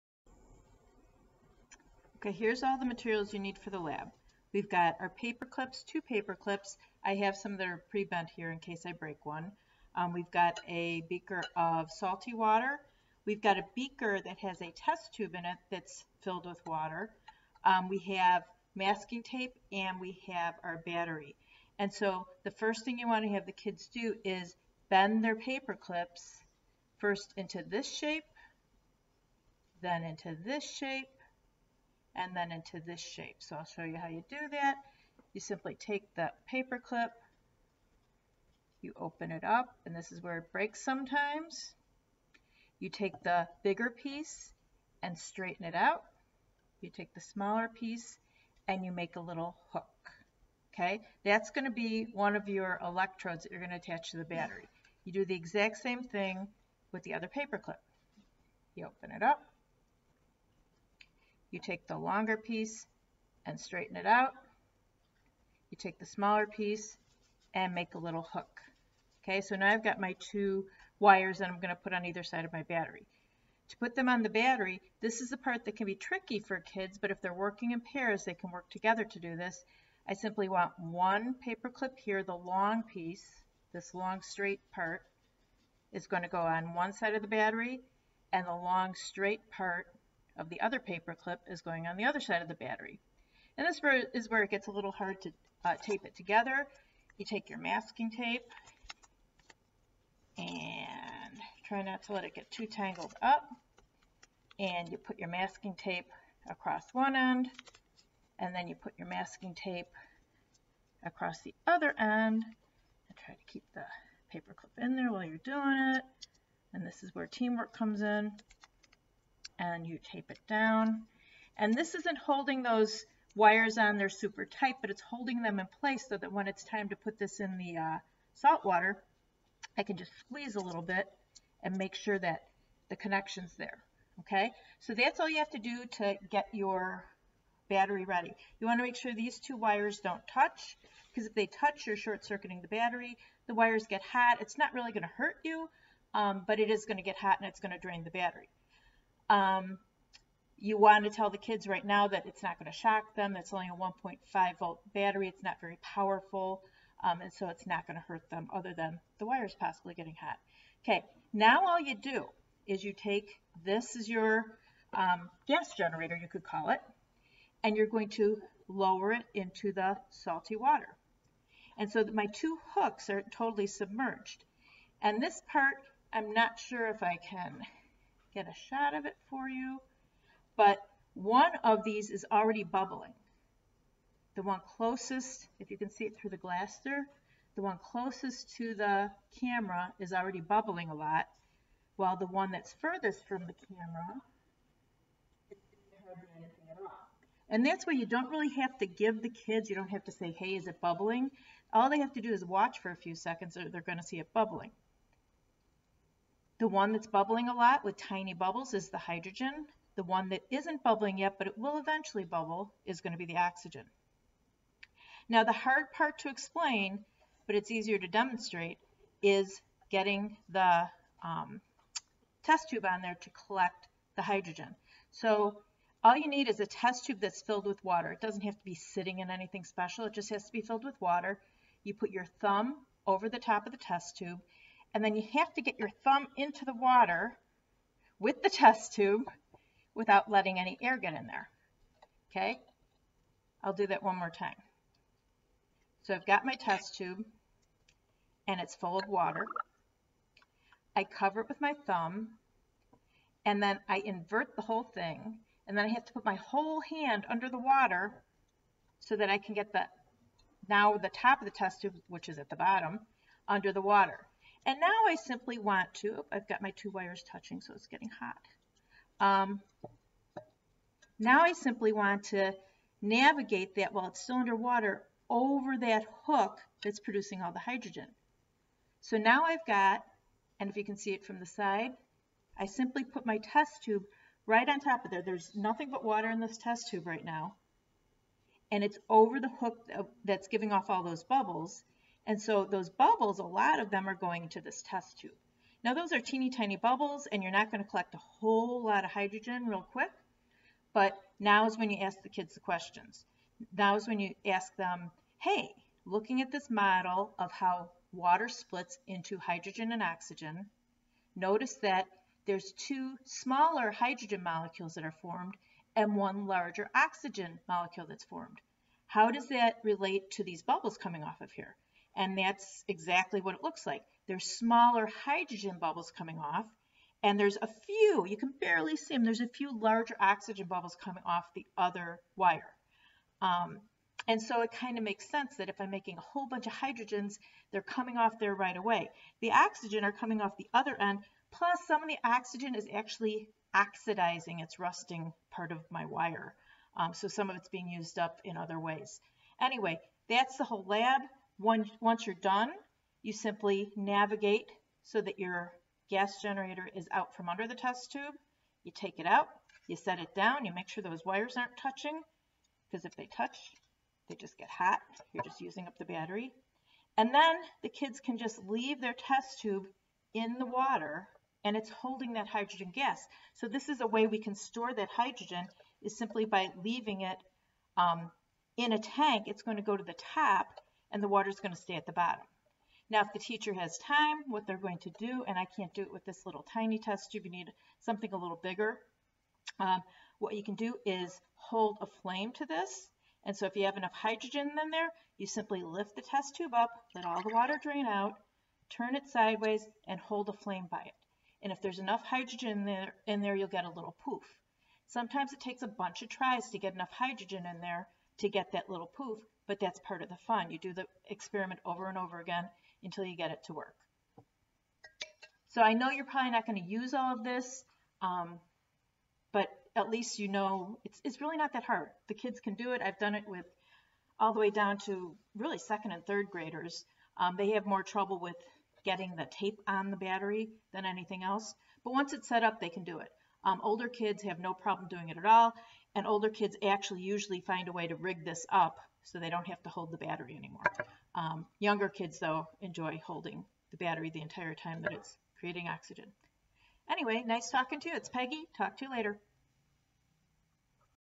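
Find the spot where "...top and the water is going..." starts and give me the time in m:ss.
6:20.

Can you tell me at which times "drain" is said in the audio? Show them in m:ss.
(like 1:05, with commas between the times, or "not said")
2:27, 6:37.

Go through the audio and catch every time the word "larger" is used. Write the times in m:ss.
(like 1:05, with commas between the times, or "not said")
5:16, 5:29.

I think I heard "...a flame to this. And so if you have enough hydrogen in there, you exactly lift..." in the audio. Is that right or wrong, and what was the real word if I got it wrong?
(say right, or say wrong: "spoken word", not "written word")
wrong: "simply", not "exactly".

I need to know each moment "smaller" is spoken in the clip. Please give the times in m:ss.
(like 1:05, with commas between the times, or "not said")
0:47, 1:06, 5:13, 5:24.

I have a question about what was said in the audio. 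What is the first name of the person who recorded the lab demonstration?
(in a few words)
Peggy.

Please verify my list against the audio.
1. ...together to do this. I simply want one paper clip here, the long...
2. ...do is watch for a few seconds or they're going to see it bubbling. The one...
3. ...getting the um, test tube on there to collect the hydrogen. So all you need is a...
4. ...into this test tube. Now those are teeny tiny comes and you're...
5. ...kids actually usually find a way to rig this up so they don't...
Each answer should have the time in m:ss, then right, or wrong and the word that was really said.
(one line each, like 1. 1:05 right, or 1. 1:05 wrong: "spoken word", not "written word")
1. 1:18 right
2. 3:22 right
3. 3:39 right
4. 4:54 wrong: "bubbles", not "comes"
5. 7:16 right.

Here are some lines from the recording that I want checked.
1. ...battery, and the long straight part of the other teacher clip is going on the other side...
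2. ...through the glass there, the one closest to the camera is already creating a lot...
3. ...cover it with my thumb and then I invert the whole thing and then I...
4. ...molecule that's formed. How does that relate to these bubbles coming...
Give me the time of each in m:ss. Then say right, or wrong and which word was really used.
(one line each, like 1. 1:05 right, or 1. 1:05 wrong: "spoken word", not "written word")
1. 1:27 wrong: "paper", not "teacher"
2. 3:06 wrong: "bubbling", not "creating"
3. 4:11 right
4. 5:17 right.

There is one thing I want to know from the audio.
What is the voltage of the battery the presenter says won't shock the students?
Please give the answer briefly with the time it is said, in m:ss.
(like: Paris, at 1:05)
1.5 volts, at 2:33.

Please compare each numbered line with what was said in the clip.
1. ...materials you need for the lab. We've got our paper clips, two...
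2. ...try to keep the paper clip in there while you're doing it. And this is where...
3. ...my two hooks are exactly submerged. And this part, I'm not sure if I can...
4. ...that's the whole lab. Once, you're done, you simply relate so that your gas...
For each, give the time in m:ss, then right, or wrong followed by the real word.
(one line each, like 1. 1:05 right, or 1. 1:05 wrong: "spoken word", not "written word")
1. 0:02 right
2. 1:53 right
3. 2:52 wrong: "totally", not "exactly"
4. 5:50 wrong: "navigate", not "relate".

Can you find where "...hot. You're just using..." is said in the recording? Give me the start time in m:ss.
6:04.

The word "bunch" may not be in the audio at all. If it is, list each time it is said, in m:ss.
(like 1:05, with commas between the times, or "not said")
5:36, 6:45.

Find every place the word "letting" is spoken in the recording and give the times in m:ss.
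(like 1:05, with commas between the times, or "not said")
4:00.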